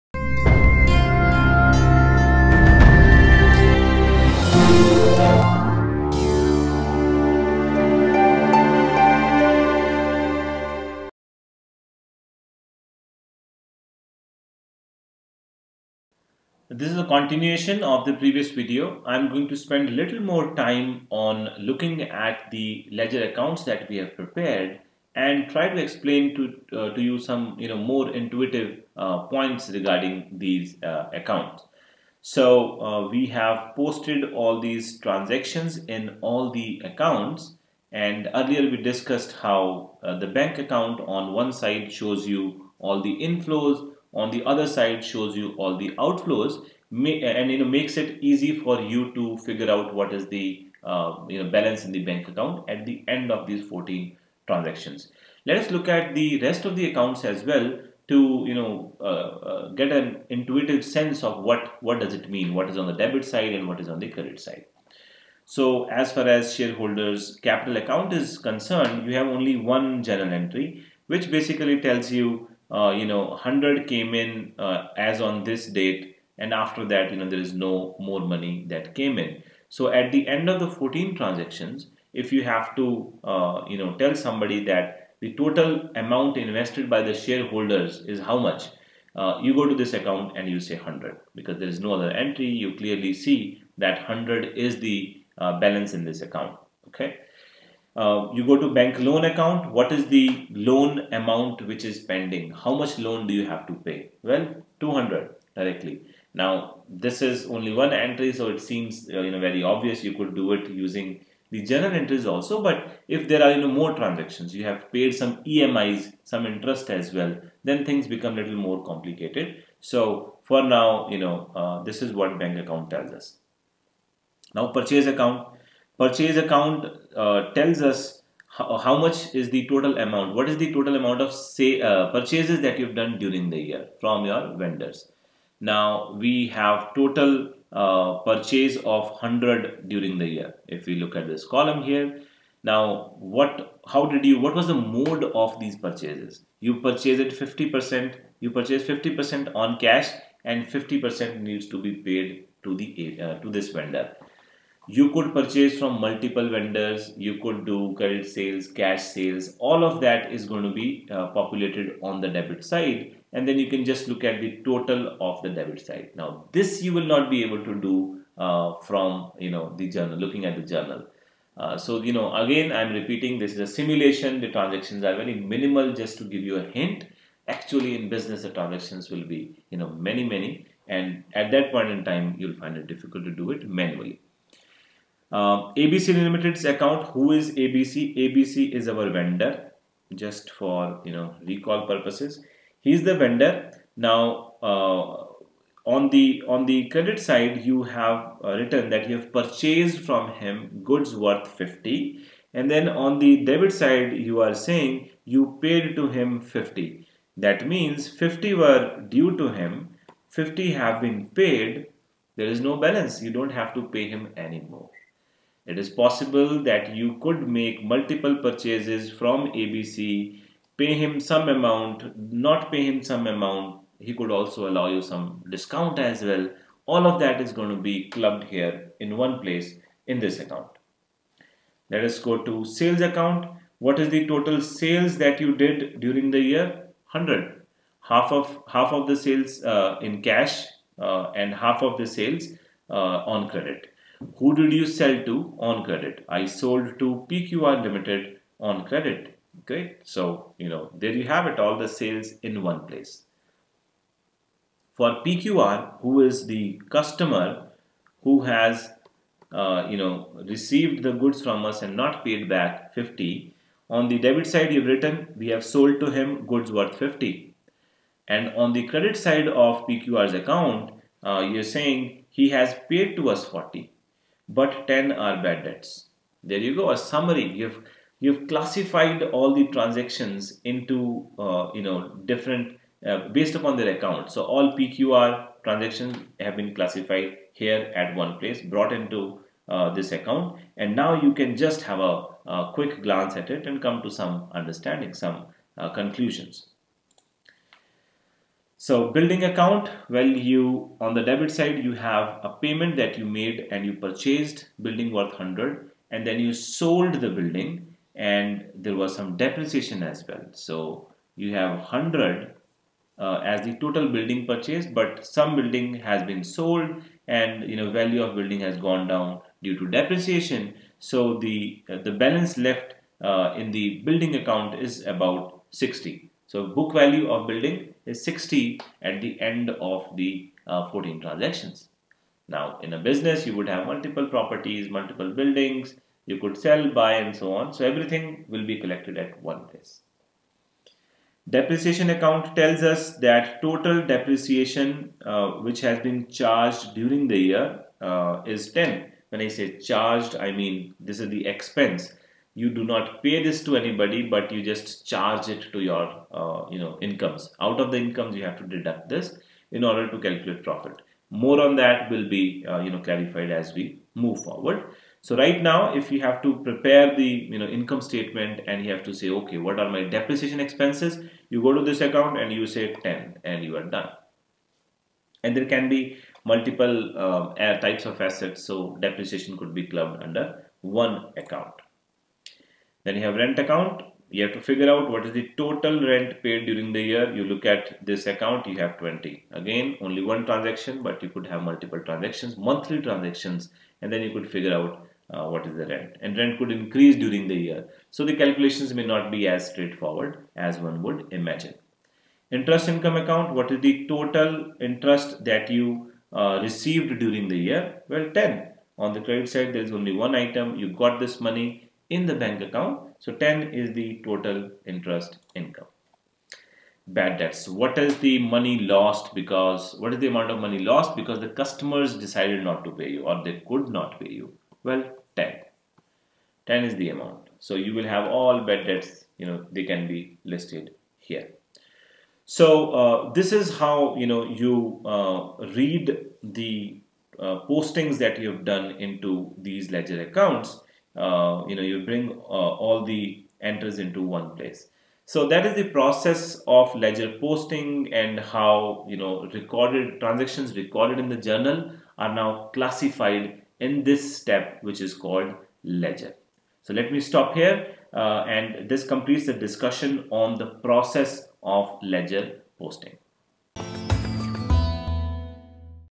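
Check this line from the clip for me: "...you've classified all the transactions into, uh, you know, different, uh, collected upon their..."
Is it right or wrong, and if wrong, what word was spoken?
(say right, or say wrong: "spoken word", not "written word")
wrong: "based", not "collected".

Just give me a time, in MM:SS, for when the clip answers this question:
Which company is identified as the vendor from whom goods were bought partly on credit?
03:05.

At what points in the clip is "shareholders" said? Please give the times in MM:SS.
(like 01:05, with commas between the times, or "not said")
01:06, 01:27.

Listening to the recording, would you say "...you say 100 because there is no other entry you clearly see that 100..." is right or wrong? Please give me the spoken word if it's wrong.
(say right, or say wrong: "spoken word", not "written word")
right.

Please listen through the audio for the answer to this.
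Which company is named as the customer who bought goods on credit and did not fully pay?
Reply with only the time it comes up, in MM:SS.
04:07.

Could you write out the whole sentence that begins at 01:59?
So for now, you know, uh, this is what bank account tells us.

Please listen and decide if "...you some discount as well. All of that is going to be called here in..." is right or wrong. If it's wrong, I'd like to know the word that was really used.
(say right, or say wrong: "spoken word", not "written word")
wrong: "clubbed", not "called".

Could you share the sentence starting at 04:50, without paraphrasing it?
And now you can just have a, a, quick glance at it and come to some understanding, some uh, conclusions.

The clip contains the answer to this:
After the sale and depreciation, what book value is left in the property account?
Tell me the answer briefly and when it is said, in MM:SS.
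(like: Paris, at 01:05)
60, at 05:25.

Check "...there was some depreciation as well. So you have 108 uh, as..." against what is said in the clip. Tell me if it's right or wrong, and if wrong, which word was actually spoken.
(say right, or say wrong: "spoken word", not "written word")
wrong: "100", not "108".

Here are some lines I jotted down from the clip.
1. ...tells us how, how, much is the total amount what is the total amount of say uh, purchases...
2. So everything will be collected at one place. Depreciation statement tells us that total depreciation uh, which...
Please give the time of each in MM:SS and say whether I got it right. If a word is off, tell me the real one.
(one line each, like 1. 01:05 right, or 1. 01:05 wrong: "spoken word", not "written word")
1. 02:07 right
2. 05:37 wrong: "account", not "statement".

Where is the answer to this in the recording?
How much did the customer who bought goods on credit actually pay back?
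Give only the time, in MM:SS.
04:32.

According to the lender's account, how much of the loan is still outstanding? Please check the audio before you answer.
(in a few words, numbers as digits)
200.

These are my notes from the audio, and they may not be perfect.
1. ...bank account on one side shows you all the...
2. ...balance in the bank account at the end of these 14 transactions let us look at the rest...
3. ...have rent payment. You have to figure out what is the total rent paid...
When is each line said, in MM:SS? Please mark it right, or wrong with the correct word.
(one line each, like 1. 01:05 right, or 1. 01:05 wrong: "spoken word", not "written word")
1. 00:40 right
2. 00:51 right
3. 06:23 wrong: "account", not "payment".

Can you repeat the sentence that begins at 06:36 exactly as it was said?
And rent could increase during the year.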